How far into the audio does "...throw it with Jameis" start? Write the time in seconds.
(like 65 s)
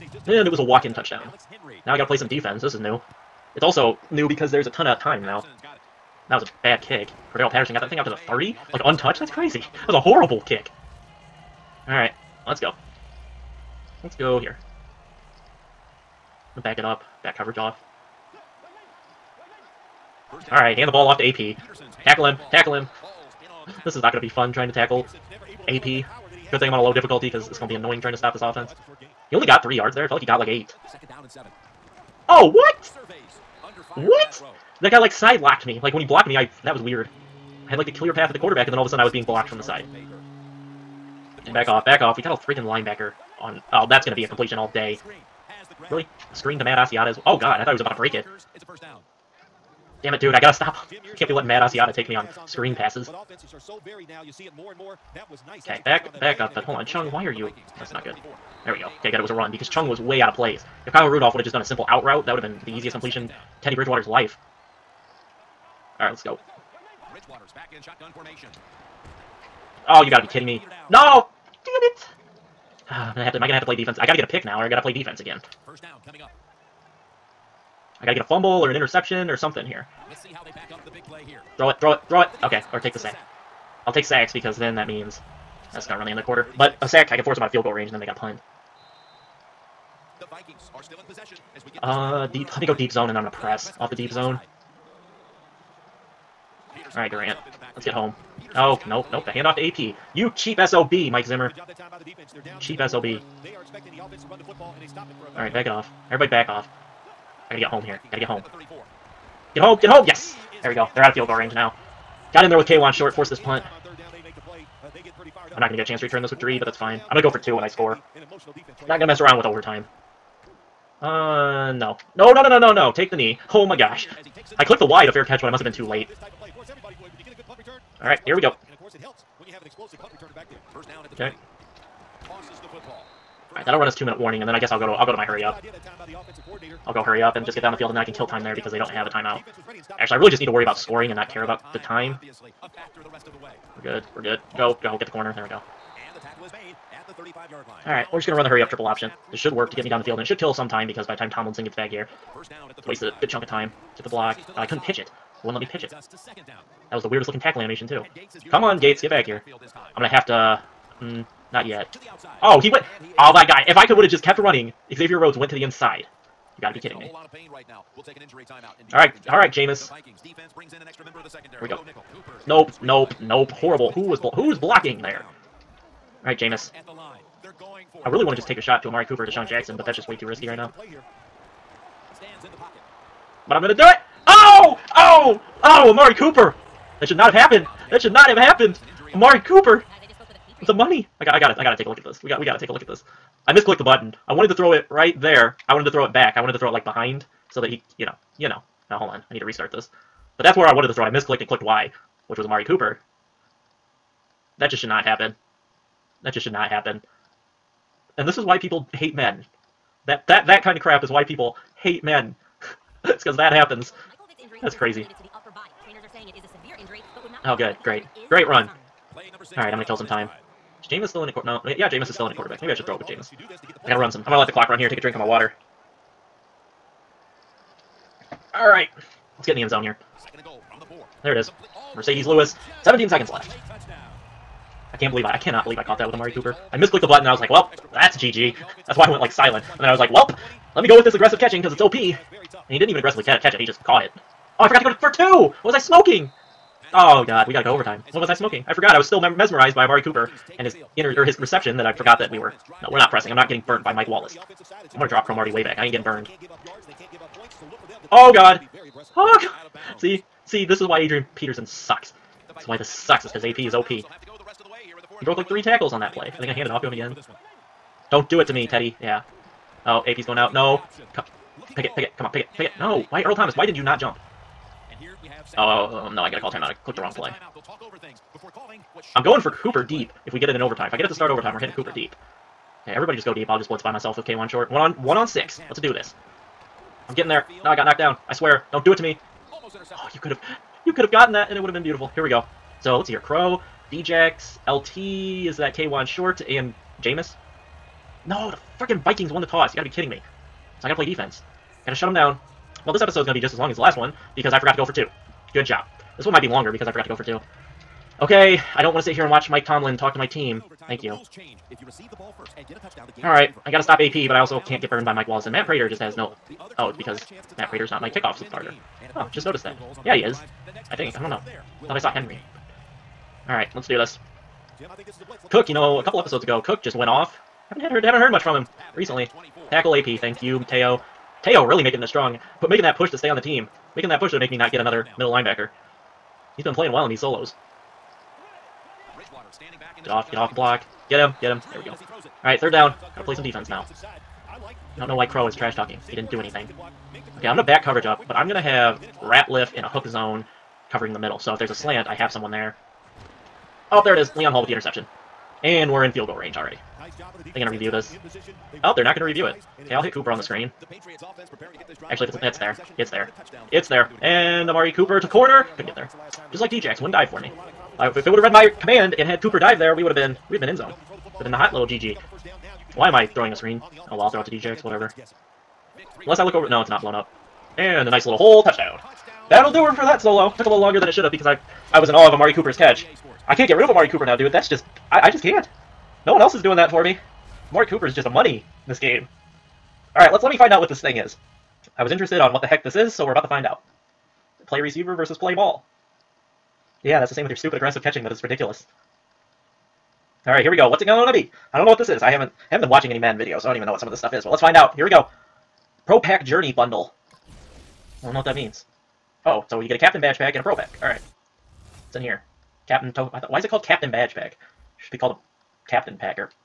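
222 s.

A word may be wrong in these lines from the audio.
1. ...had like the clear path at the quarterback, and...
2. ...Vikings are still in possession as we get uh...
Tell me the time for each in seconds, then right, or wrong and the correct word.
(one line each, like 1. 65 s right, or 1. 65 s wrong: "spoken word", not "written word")
1. 37 s right
2. 90 s right.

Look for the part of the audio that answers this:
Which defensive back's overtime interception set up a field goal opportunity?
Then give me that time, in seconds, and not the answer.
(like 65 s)
354 s.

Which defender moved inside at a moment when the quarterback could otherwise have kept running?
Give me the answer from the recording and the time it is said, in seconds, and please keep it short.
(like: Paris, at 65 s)
Xavier Rhodes, at 164 s.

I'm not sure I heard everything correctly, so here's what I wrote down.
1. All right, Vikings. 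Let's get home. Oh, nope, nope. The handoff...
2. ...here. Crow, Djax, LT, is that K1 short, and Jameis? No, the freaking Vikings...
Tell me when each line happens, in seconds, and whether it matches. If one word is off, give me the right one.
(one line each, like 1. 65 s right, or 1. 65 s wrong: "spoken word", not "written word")
1. 96 s wrong: "Durant", not "Vikings"
2. 293 s right.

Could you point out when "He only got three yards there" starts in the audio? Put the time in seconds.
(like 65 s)
29 s.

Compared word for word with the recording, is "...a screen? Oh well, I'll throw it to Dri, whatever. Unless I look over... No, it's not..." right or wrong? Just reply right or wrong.
wrong.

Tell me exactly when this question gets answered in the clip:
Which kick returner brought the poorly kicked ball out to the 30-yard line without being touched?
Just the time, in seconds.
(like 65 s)
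7 s.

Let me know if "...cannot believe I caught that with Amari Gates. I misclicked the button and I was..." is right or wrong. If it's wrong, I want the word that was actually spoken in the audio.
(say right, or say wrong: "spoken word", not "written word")
wrong: "Cooper", not "Gates".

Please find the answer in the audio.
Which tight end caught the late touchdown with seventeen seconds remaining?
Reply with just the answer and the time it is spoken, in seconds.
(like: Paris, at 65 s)
Marcedes Lewis, at 231 s.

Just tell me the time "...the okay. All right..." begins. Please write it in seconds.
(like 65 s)
131 s.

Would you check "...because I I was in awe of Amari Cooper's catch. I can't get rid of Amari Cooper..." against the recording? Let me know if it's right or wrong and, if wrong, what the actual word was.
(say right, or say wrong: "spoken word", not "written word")
right.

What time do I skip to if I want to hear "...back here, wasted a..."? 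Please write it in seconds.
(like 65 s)
151 s.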